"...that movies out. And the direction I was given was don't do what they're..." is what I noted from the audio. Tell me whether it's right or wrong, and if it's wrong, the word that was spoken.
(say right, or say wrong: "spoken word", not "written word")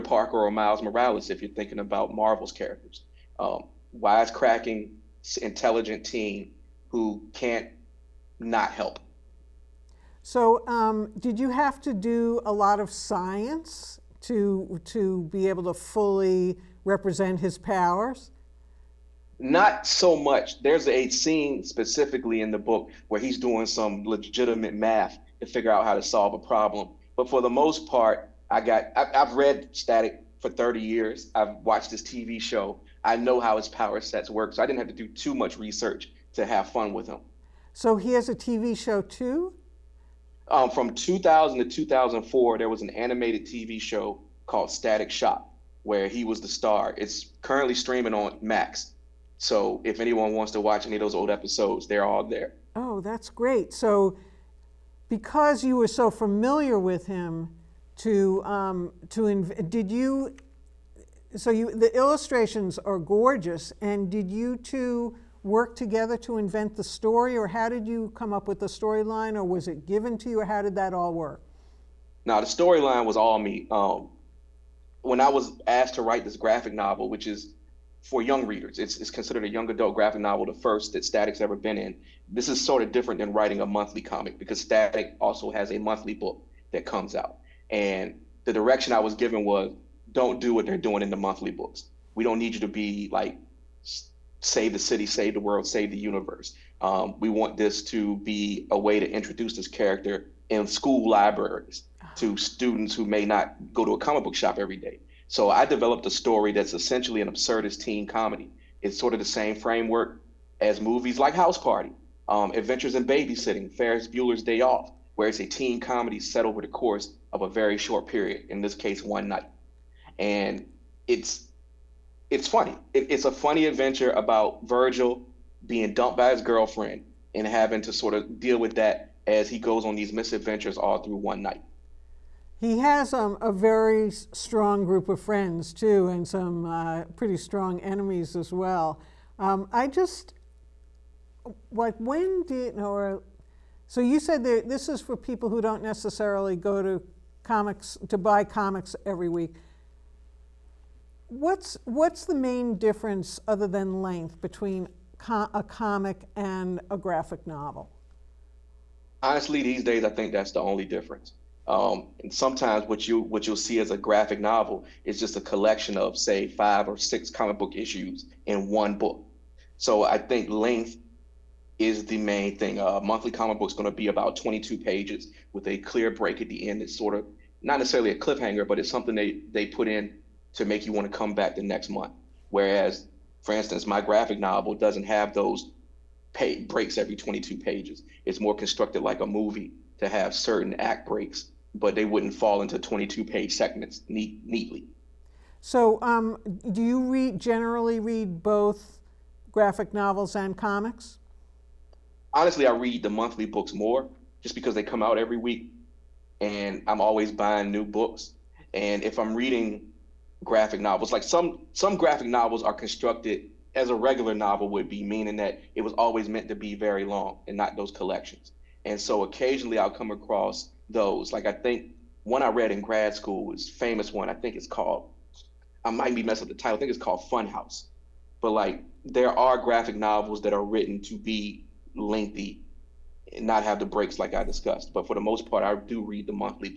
wrong: "comes", not "movies".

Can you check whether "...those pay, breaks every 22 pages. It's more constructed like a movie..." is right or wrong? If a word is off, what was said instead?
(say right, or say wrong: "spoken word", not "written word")
right.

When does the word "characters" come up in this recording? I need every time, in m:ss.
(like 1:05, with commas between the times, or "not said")
0:02, 1:39.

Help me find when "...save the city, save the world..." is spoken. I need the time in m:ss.
1:34.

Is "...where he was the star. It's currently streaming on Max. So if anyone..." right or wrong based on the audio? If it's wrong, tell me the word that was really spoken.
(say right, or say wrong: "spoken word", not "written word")
right.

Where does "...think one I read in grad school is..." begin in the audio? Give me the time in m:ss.
3:41.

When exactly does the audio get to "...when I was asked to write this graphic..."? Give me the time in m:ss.
1:15.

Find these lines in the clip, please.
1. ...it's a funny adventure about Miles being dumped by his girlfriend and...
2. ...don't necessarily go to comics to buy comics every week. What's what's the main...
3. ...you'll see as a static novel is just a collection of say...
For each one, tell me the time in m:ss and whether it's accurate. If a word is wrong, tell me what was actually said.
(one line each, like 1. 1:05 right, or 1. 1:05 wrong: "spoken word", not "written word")
1. 2:03 wrong: "Virgil", not "Miles"
2. 2:25 right
3. 2:43 wrong: "graphic", not "static".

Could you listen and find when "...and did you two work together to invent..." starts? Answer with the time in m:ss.
1:03.